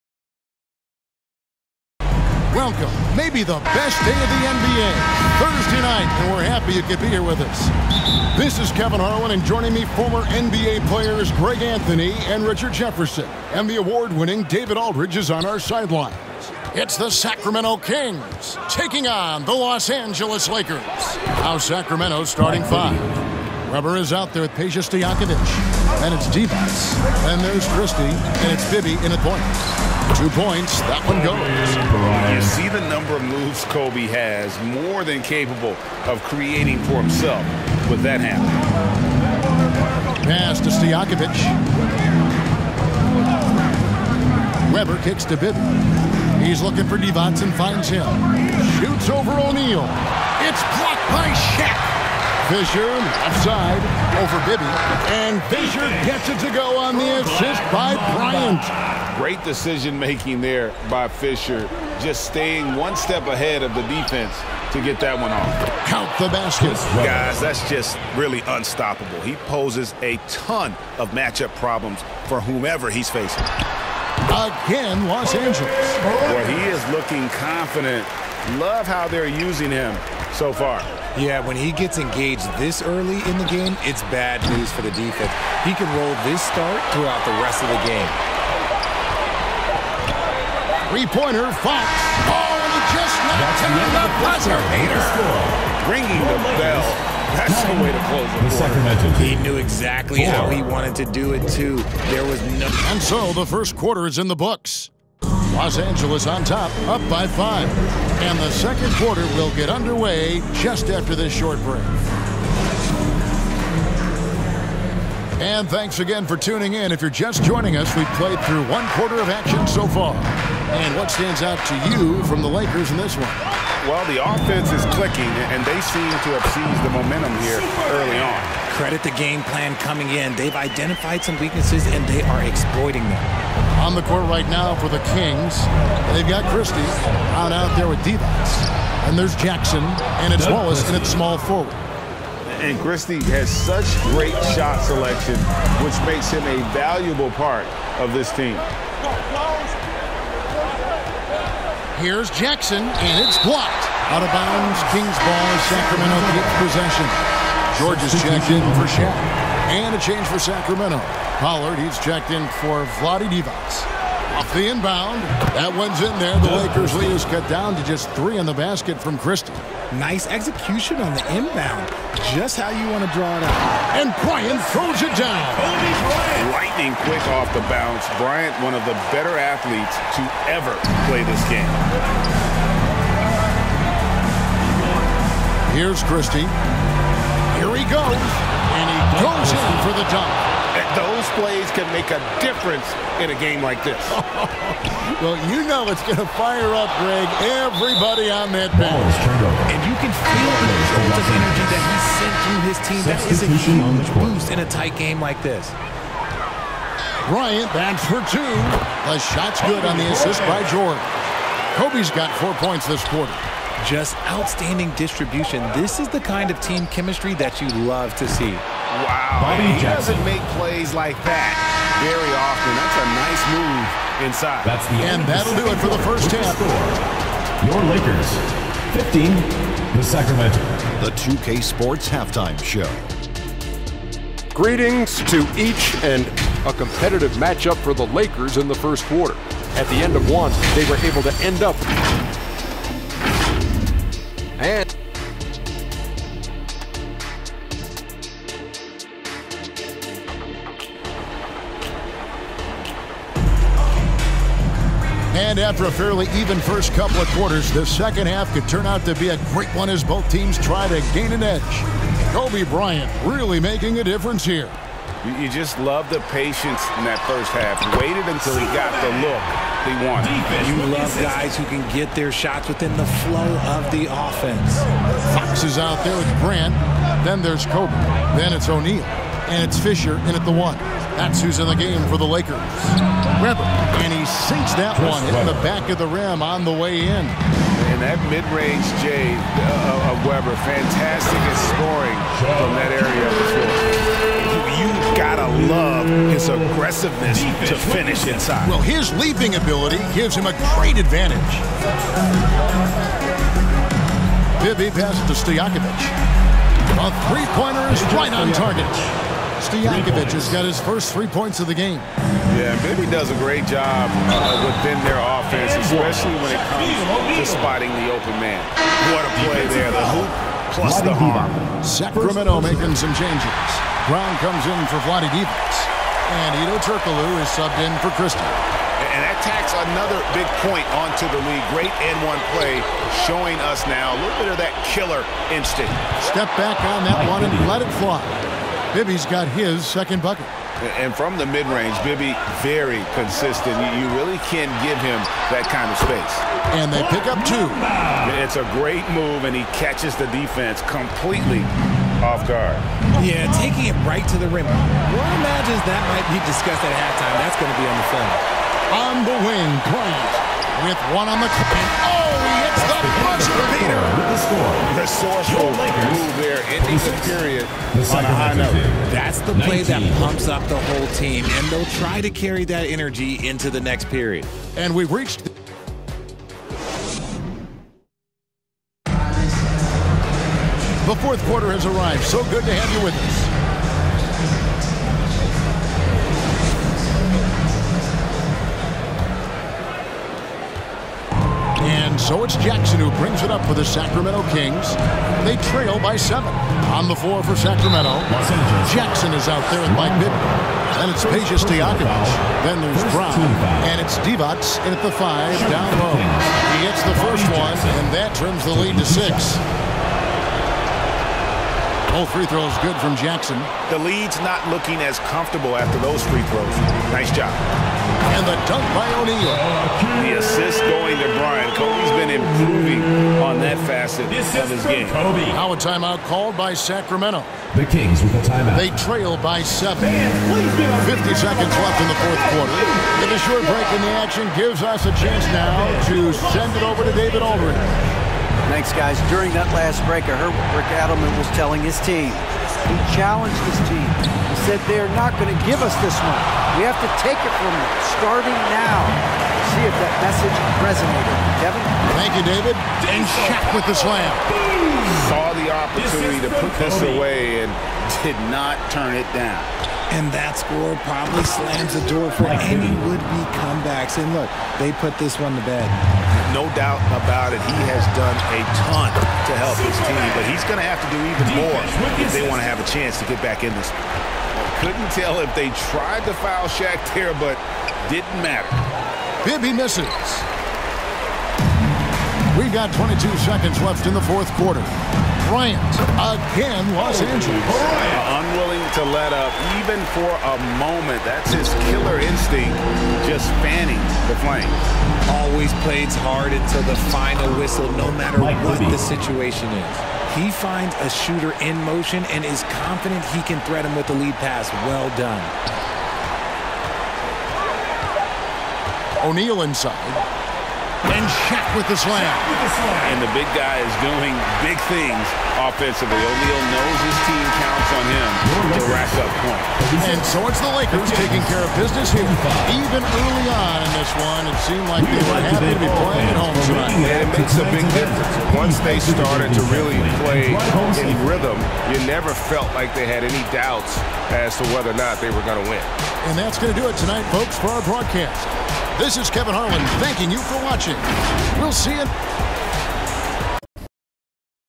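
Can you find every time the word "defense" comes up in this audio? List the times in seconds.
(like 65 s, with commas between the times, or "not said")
63 s, 84 s, 350 s.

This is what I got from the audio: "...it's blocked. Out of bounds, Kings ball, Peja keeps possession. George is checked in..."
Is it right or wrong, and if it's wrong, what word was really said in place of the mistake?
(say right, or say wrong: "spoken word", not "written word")
wrong: "Sacramento", not "Peja".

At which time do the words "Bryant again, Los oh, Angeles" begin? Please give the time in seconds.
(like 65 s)
485 s.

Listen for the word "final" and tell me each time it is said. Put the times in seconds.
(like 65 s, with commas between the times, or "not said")
497 s.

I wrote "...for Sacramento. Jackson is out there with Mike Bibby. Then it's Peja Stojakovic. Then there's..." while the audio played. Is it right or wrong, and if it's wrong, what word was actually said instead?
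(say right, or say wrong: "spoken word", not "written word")
right.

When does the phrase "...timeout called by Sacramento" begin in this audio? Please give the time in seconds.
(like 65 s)
425 s.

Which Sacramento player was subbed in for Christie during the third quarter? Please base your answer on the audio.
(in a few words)
Hedo Turkoglu.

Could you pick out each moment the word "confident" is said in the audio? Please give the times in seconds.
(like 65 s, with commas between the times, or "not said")
77 s, 502 s.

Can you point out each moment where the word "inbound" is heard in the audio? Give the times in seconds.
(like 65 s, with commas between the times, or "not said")
164 s, 171 s.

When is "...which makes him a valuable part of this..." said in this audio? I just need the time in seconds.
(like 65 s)
145 s.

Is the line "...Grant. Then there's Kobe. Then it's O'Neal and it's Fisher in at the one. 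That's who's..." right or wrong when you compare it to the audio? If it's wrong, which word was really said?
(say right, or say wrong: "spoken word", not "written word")
right.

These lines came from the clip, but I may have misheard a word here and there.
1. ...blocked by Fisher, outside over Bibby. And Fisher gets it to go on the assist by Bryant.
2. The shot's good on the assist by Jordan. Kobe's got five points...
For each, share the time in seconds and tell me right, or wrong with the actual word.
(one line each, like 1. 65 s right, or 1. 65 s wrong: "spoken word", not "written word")
1. 50 s right
2. 209 s wrong: "four", not "five".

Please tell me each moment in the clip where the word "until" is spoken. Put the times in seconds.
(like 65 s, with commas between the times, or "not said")
268 s, 496 s.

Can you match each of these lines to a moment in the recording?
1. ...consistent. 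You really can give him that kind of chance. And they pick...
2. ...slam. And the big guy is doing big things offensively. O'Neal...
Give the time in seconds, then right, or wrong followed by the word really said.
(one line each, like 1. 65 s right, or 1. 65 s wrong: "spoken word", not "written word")
1. 343 s wrong: "space", not "chance"
2. 512 s right.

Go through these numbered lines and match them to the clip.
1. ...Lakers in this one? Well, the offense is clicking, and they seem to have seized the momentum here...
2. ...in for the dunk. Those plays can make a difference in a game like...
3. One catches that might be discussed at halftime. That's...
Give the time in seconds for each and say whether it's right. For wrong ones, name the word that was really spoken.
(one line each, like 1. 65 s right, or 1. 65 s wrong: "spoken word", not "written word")
1. 122 s right
2. 189 s right
3. 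354 s wrong: "imagines", not "catches".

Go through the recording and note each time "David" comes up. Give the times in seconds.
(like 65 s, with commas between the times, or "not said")
14 s, 437 s, 452 s.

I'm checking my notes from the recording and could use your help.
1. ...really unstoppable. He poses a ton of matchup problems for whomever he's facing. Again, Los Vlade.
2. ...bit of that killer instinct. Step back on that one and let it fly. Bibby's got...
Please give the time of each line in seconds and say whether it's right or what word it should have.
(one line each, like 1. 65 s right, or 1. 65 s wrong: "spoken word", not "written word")
1. 68 s wrong: "Angeles", not "Vlade"
2. 334 s right.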